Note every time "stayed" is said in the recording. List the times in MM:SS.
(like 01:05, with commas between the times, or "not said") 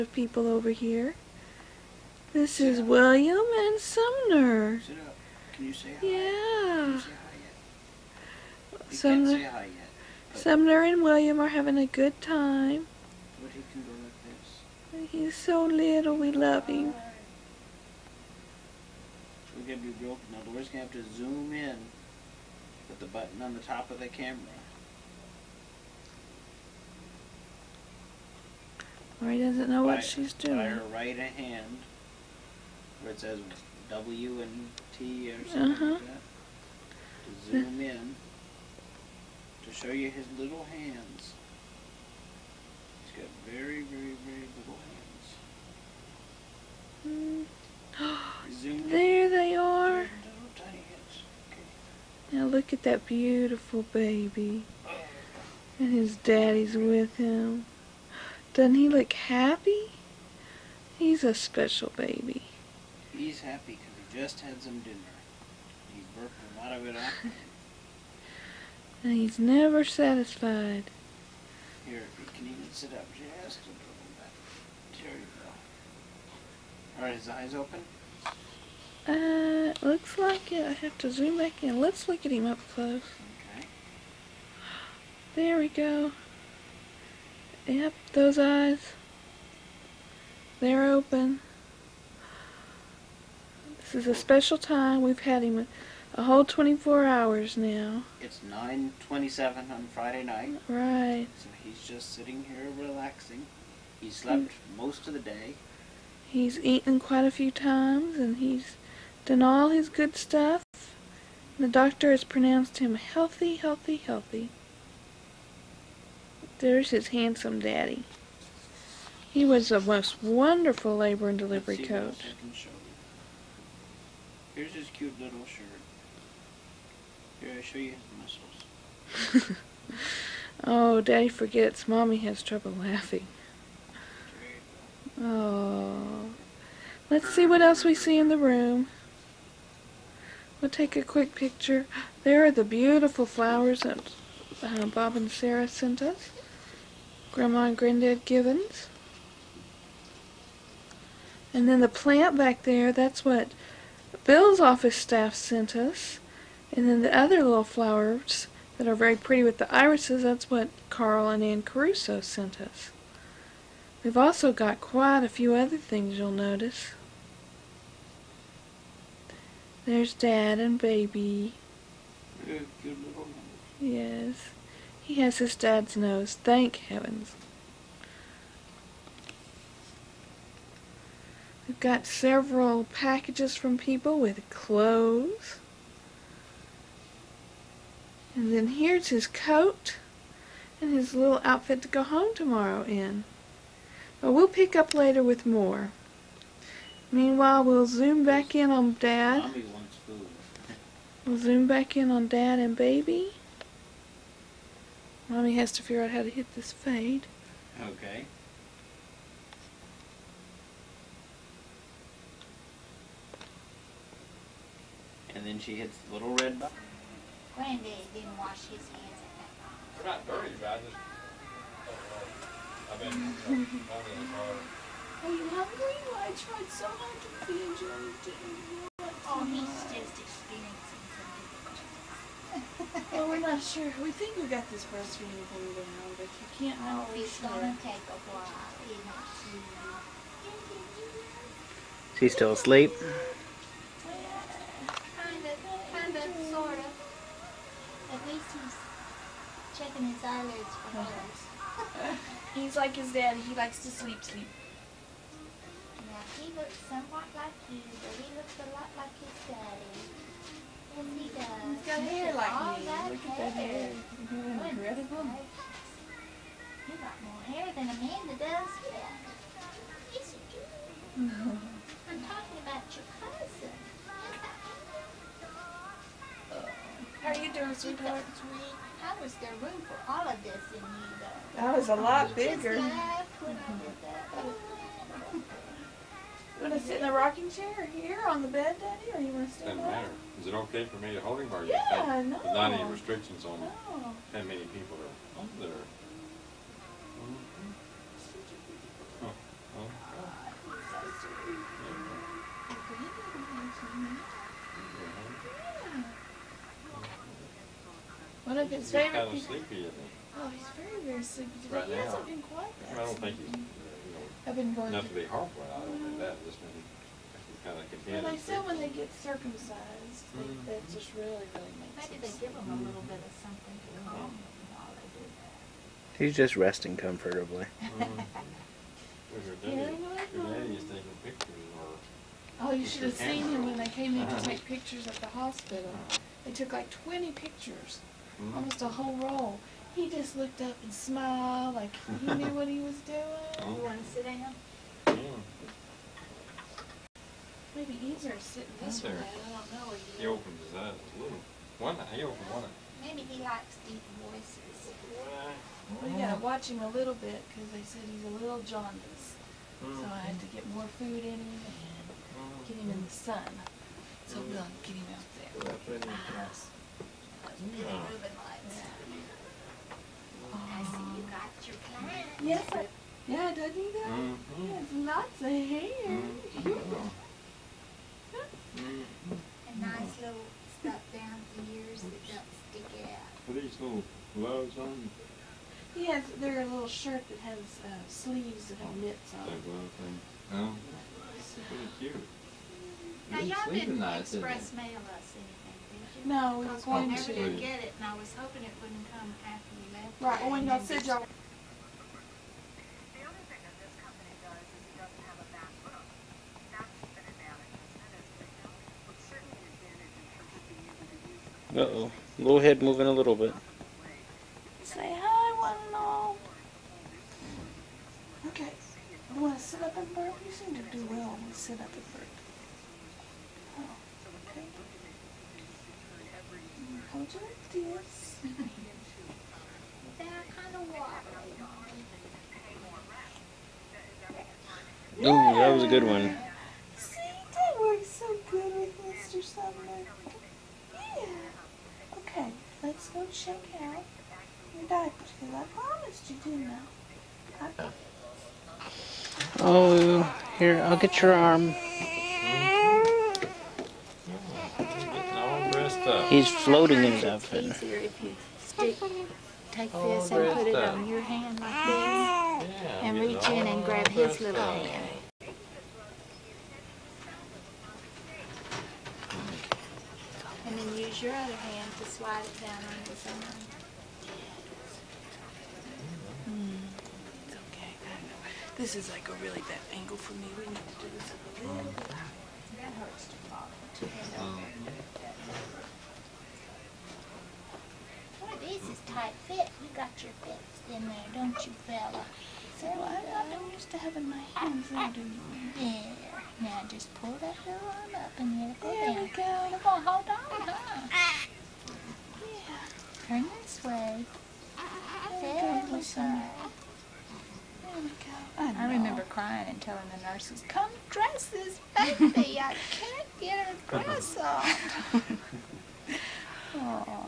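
not said.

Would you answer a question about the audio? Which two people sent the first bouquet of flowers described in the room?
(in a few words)
Bob and Sarah.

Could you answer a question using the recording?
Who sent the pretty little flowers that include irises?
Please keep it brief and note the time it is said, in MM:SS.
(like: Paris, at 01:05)
Carl and Ann Caruso, at 02:40.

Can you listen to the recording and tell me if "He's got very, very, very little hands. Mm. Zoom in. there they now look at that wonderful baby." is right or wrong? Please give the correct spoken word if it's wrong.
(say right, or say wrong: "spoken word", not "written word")
wrong: "beautiful", not "wonderful".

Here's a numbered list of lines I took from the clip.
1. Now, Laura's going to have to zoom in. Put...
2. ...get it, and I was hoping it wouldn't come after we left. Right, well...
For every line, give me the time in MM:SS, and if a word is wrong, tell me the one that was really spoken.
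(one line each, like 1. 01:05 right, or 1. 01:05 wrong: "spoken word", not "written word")
1. 00:20 right
2. 06:37 right.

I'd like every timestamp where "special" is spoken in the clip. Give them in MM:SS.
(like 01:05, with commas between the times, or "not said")
01:01, 01:34.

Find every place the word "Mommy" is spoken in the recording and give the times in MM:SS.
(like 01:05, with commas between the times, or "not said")
02:11, 03:25.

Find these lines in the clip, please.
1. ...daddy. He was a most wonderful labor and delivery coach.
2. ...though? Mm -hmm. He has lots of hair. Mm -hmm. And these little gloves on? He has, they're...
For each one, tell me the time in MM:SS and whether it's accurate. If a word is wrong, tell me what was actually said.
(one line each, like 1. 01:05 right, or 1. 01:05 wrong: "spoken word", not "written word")
1. 01:57 right
2. 06:13 right.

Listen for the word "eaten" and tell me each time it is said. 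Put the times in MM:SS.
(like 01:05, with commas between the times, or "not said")
01:46.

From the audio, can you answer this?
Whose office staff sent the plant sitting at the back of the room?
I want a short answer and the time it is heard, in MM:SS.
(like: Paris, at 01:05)
Bill's, at 02:34.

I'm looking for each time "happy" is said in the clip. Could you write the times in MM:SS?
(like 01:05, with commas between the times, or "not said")
00:59, 01:03.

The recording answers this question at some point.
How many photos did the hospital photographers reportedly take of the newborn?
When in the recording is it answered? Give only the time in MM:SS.
05:36.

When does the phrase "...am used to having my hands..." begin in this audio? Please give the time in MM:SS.
08:13.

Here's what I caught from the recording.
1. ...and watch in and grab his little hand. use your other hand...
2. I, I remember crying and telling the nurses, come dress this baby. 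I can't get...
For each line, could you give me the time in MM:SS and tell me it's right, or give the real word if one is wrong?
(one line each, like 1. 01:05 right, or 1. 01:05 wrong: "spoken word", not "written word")
1. 07:43 wrong: "reach", not "watch"
2. 08:28 right.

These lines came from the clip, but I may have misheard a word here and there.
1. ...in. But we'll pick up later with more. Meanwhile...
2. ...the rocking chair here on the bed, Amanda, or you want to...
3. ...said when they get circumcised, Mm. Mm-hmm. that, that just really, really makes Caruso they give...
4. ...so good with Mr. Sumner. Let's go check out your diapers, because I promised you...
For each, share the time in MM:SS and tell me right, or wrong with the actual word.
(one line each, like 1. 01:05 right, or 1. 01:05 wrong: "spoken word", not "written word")
1. 03:12 right
2. 04:47 wrong: "Daddy", not "Amanda"
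3. 05:18 wrong: "Maybe", not "Caruso"
4. 07:18 right.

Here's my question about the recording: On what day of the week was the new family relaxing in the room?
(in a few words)
Friday.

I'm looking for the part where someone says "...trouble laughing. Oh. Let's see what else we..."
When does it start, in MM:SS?
02:12.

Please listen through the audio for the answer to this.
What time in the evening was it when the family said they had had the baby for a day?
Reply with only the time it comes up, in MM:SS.
01:38.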